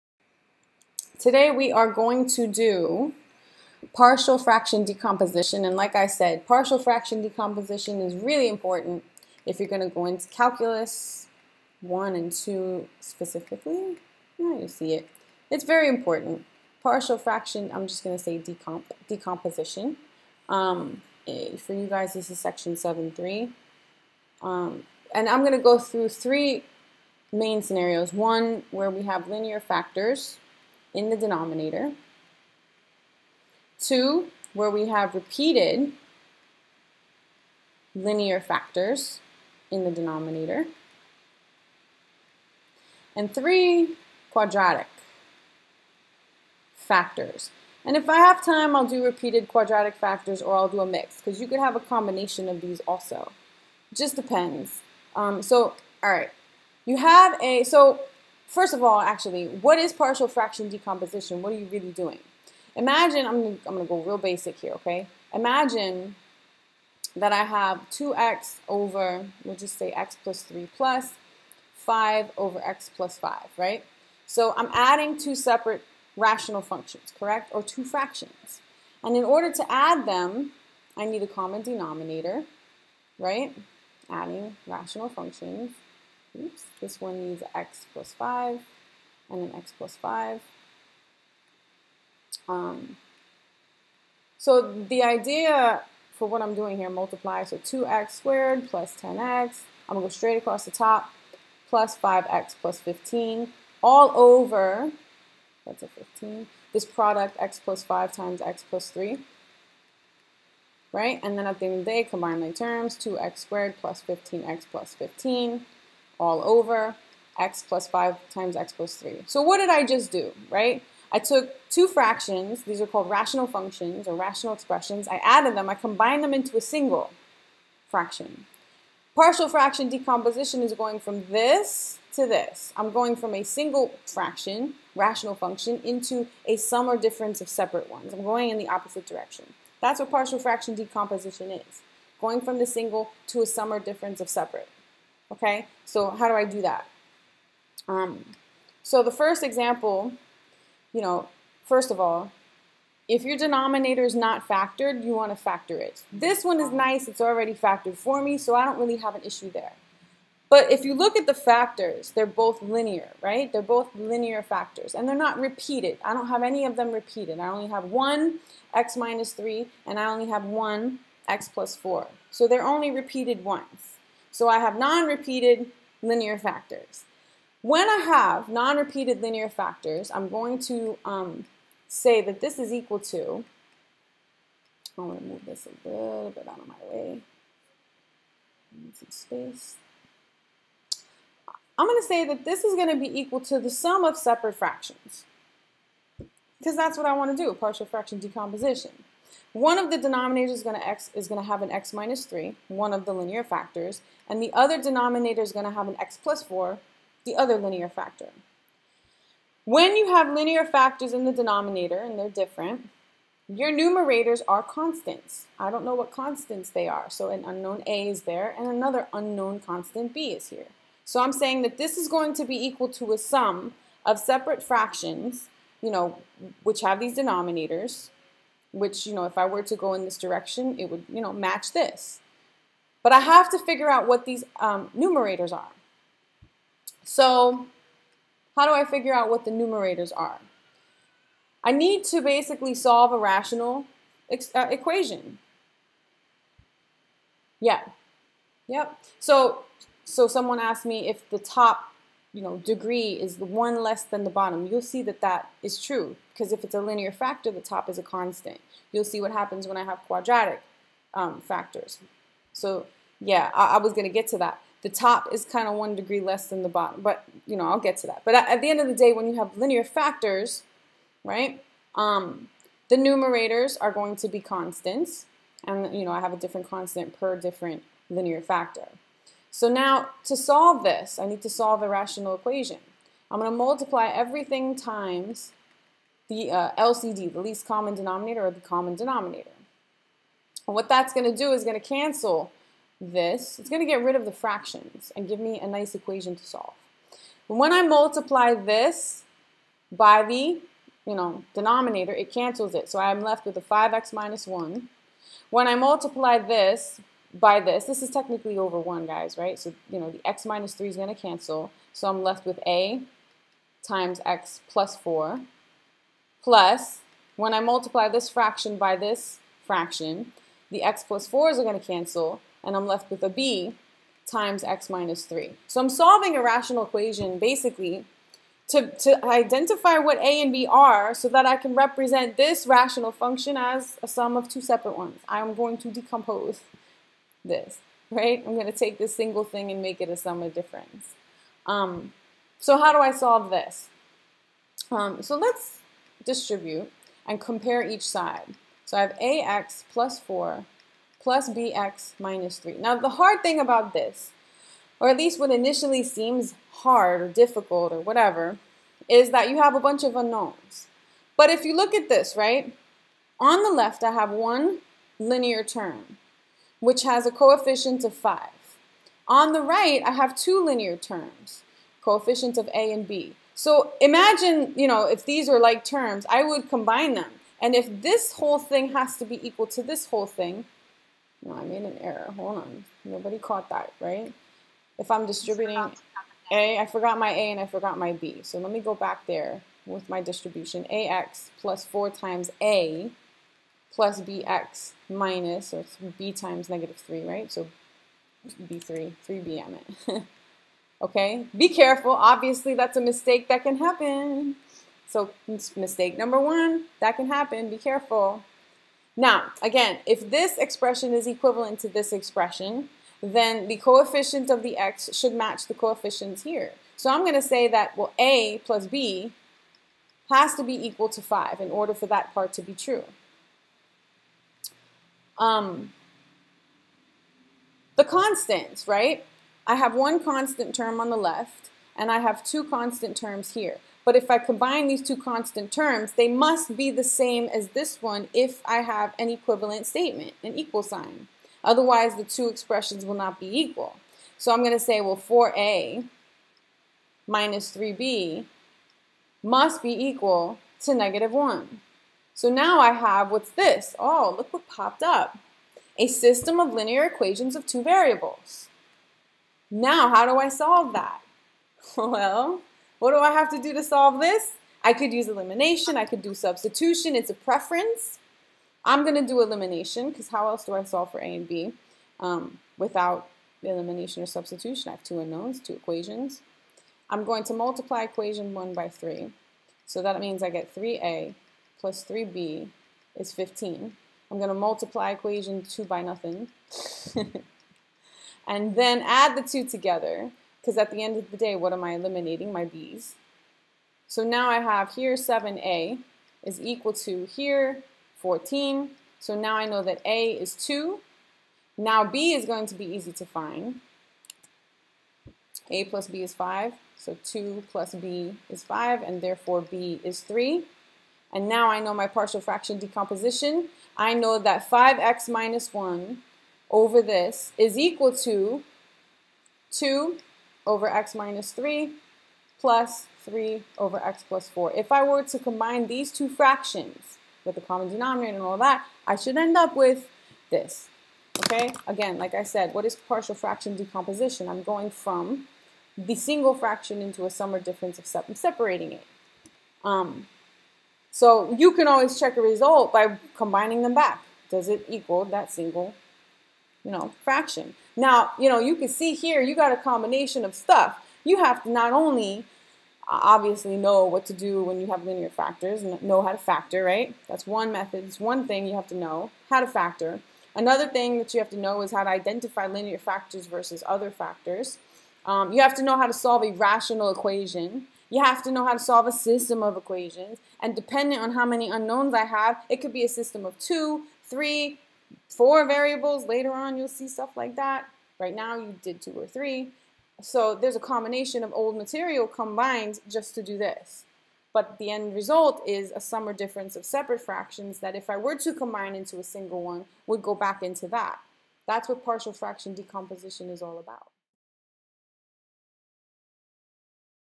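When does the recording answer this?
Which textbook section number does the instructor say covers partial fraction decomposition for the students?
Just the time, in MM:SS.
00:22.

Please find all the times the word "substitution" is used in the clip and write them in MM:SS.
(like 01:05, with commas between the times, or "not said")
07:46, 07:54.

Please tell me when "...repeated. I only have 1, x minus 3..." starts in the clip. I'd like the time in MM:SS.
02:46.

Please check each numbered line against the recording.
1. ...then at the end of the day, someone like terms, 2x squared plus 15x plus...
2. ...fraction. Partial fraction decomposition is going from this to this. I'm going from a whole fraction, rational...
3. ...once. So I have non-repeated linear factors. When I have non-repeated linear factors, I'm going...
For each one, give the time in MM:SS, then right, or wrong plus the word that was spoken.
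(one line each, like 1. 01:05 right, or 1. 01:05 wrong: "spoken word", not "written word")
1. 01:51 wrong: "combine", not "someone"
2. 02:07 wrong: "single", not "whole"
3. 02:53 right.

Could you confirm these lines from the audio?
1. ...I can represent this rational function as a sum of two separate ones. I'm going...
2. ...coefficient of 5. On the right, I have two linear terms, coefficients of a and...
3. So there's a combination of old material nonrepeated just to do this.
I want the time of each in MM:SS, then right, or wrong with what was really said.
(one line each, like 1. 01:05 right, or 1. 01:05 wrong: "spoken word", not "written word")
1. 05:31 right
2. 06:07 right
3. 09:40 wrong: "combined", not "nonrepeated".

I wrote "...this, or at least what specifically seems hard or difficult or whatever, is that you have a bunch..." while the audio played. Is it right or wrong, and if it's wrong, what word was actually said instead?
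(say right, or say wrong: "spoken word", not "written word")
wrong: "initially", not "specifically".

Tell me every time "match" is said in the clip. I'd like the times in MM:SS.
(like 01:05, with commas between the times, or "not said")
03:51, 06:55.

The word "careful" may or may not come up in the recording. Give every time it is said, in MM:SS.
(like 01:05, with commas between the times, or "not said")
06:41, 06:47.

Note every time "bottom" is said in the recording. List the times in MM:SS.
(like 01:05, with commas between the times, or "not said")
04:14, 04:26.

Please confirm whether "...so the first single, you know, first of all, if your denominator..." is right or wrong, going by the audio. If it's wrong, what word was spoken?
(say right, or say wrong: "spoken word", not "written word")
wrong: "example", not "single".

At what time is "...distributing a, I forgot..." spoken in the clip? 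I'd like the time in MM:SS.
06:25.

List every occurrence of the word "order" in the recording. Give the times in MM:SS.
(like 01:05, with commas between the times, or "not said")
01:19, 07:01.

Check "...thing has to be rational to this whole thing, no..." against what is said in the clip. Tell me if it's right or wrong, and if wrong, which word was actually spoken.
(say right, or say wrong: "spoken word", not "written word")
wrong: "equal", not "rational".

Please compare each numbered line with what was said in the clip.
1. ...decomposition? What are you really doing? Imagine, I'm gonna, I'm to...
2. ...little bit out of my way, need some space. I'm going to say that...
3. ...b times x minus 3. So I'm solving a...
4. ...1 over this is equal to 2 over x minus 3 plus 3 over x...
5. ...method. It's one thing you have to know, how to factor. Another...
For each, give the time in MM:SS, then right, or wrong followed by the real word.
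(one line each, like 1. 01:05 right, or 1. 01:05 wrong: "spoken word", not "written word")
1. 01:00 right
2. 03:05 right
3. 05:23 right
4. 08:35 right
5. 09:17 right.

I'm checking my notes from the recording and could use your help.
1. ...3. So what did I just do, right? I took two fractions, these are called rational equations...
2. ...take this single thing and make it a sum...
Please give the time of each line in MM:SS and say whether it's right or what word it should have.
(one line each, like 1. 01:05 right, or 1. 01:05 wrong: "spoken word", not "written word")
1. 01:58 wrong: "functions", not "equations"
2. 05:38 right.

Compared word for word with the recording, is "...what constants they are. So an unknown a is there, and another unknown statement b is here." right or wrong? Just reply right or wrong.
wrong.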